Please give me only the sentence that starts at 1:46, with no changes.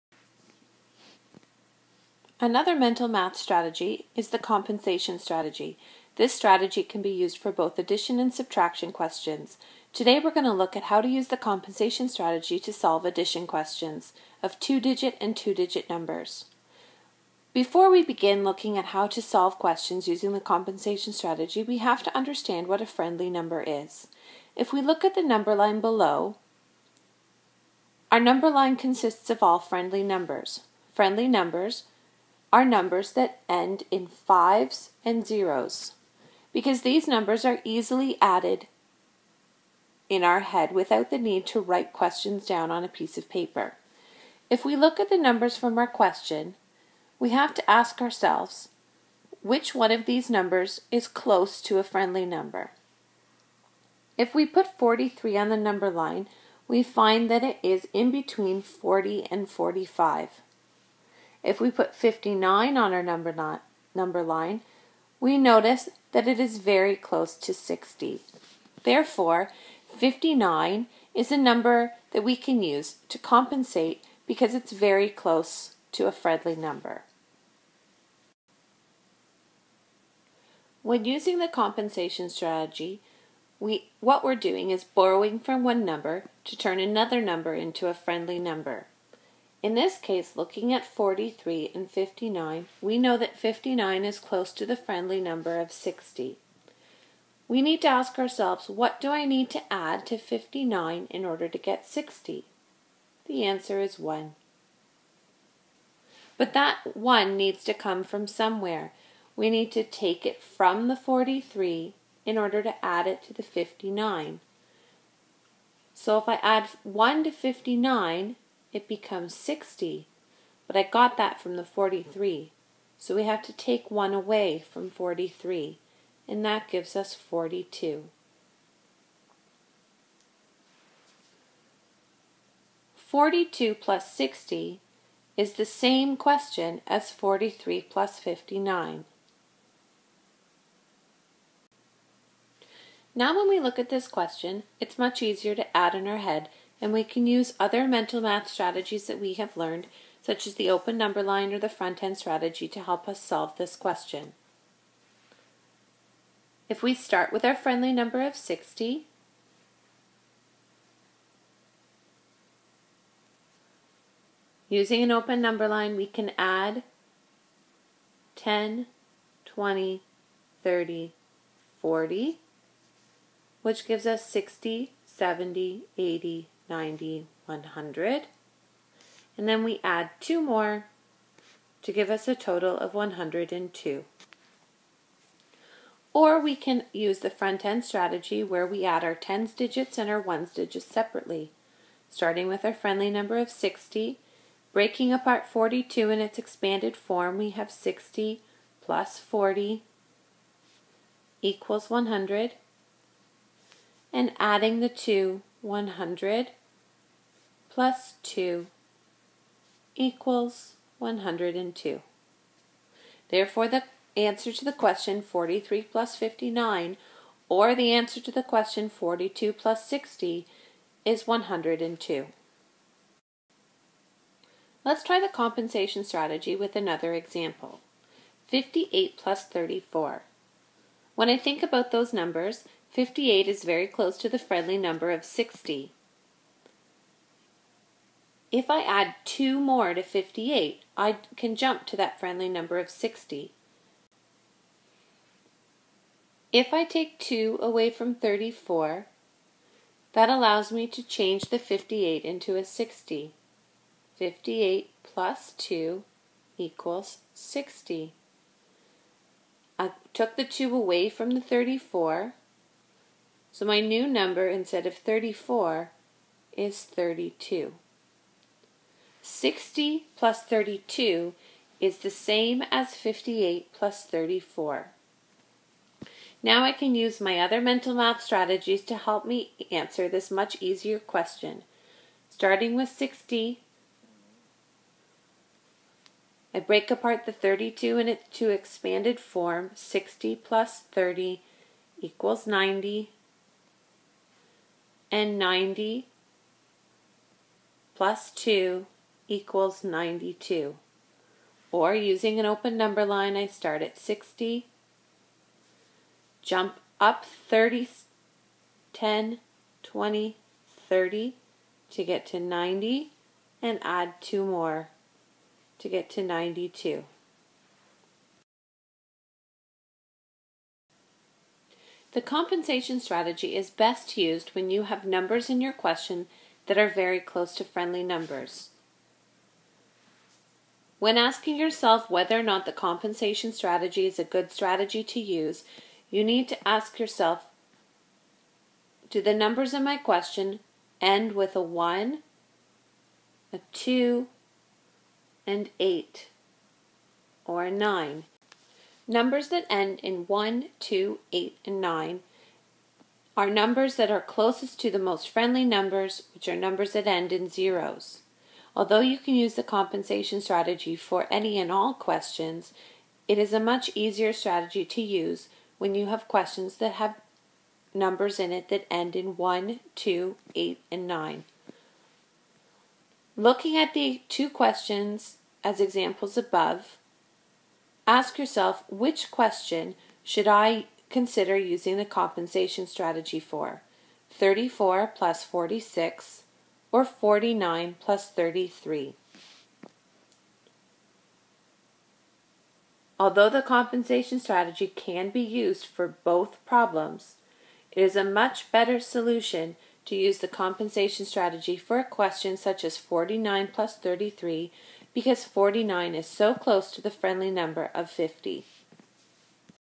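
But that 1 needs to come from somewhere.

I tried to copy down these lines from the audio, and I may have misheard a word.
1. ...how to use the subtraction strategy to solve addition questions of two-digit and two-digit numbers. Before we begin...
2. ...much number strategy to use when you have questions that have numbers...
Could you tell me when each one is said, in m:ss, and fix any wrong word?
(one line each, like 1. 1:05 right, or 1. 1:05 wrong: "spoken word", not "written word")
1. 0:10 wrong: "compensation", not "subtraction"
2. 6:03 wrong: "easier", not "number".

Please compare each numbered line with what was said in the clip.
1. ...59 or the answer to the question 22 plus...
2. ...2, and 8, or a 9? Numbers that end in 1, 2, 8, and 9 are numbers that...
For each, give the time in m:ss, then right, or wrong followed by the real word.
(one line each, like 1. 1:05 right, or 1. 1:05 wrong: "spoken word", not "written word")
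1. 3:36 wrong: "42", not "22"
2. 5:43 right.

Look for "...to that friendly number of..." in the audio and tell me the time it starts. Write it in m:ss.
4:01.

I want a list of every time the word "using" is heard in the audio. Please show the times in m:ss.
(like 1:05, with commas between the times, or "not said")
0:20, 1:21, 2:44, 5:01, 6:21.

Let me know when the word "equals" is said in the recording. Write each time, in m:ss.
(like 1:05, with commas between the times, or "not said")
3:21, 3:29, 4:16, 4:51, 4:59.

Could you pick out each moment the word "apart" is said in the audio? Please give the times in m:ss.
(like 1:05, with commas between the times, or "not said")
3:15, 4:46.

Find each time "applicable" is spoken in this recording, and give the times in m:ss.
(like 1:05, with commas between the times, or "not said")
not said.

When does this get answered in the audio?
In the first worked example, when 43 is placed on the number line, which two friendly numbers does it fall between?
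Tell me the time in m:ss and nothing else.
0:58.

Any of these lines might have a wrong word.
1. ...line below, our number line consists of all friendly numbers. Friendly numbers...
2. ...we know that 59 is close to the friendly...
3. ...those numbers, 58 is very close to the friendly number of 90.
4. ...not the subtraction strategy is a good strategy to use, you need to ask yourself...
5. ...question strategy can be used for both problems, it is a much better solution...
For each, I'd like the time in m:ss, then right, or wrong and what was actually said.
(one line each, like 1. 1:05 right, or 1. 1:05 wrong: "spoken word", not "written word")
1. 0:25 right
2. 1:32 right
3. 3:51 wrong: "60", not "90"
4. 5:32 wrong: "compensation", not "subtraction"
5. 6:33 wrong: "compensation", not "question".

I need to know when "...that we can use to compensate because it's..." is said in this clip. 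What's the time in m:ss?
1:12.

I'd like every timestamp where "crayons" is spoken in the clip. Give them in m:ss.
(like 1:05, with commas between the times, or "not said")
not said.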